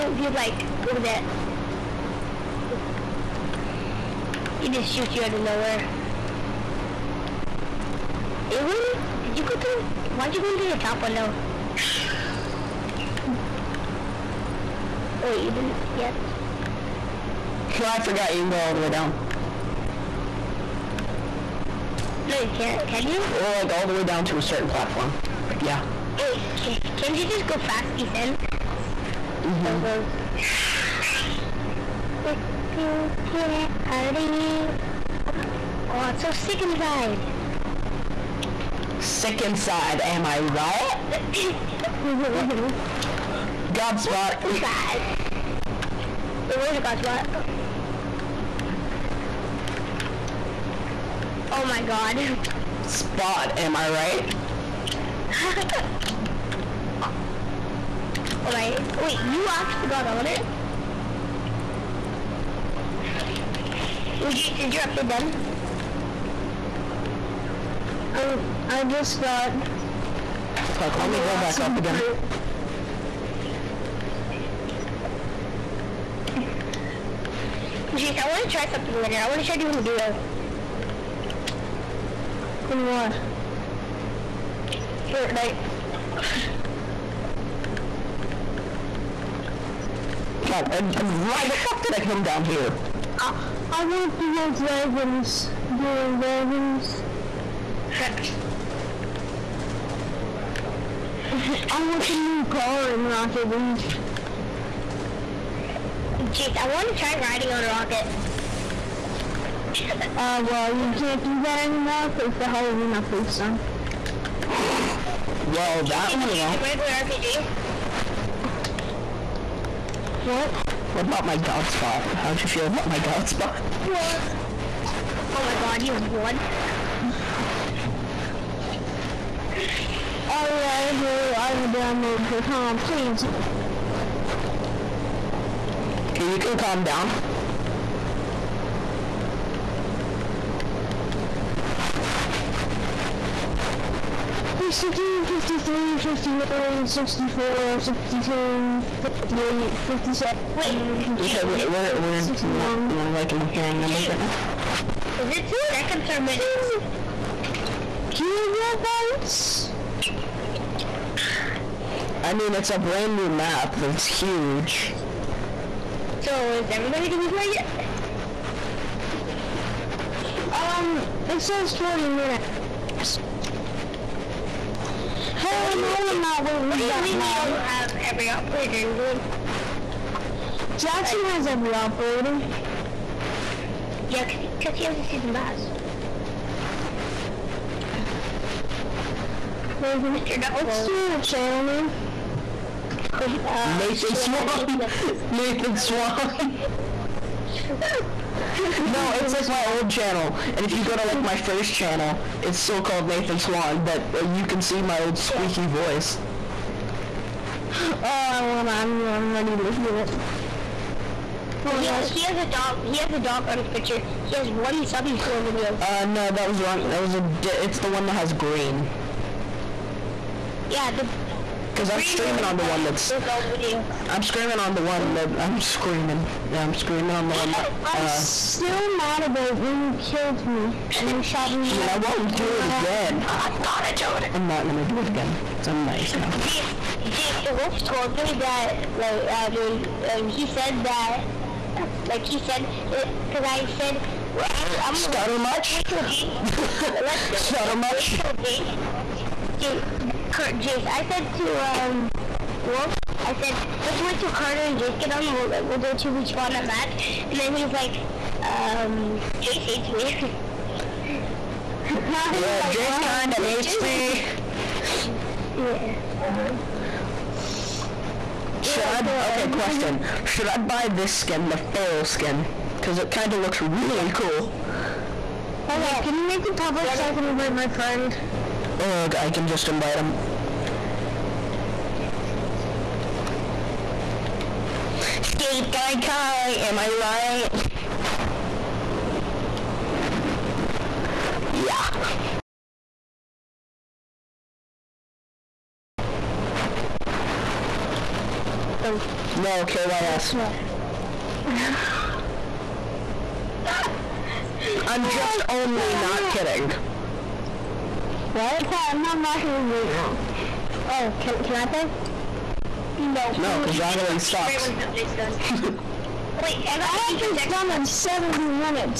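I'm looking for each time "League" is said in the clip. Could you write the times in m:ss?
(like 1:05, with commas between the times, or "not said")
1:43, 5:09, 5:14.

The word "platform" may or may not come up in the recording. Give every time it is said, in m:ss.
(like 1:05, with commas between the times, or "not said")
0:24.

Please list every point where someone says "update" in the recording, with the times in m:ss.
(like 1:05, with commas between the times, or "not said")
1:04, 1:52.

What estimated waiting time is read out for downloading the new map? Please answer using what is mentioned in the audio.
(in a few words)
40 minutes.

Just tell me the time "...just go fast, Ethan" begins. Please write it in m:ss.
0:27.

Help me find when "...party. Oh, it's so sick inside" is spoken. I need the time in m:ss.
0:33.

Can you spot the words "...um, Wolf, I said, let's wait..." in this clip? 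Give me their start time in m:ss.
4:11.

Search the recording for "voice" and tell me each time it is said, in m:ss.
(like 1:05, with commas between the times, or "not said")
3:25.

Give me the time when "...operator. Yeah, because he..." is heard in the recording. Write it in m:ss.
3:01.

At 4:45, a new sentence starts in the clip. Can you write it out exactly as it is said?
Skate guy Kai, am I right?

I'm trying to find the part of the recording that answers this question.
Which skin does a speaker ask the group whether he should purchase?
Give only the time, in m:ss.
4:31.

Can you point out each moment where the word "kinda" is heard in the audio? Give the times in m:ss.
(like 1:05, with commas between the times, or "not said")
4:22, 4:33.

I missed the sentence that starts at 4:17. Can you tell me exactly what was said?
And then he's like, um, Jace hates me.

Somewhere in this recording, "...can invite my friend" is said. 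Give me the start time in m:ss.
4:37.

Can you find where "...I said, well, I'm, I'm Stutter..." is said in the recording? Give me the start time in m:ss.
4:03.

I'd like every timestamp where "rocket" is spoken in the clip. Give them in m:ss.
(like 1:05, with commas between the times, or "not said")
1:43, 1:47, 5:09, 5:13.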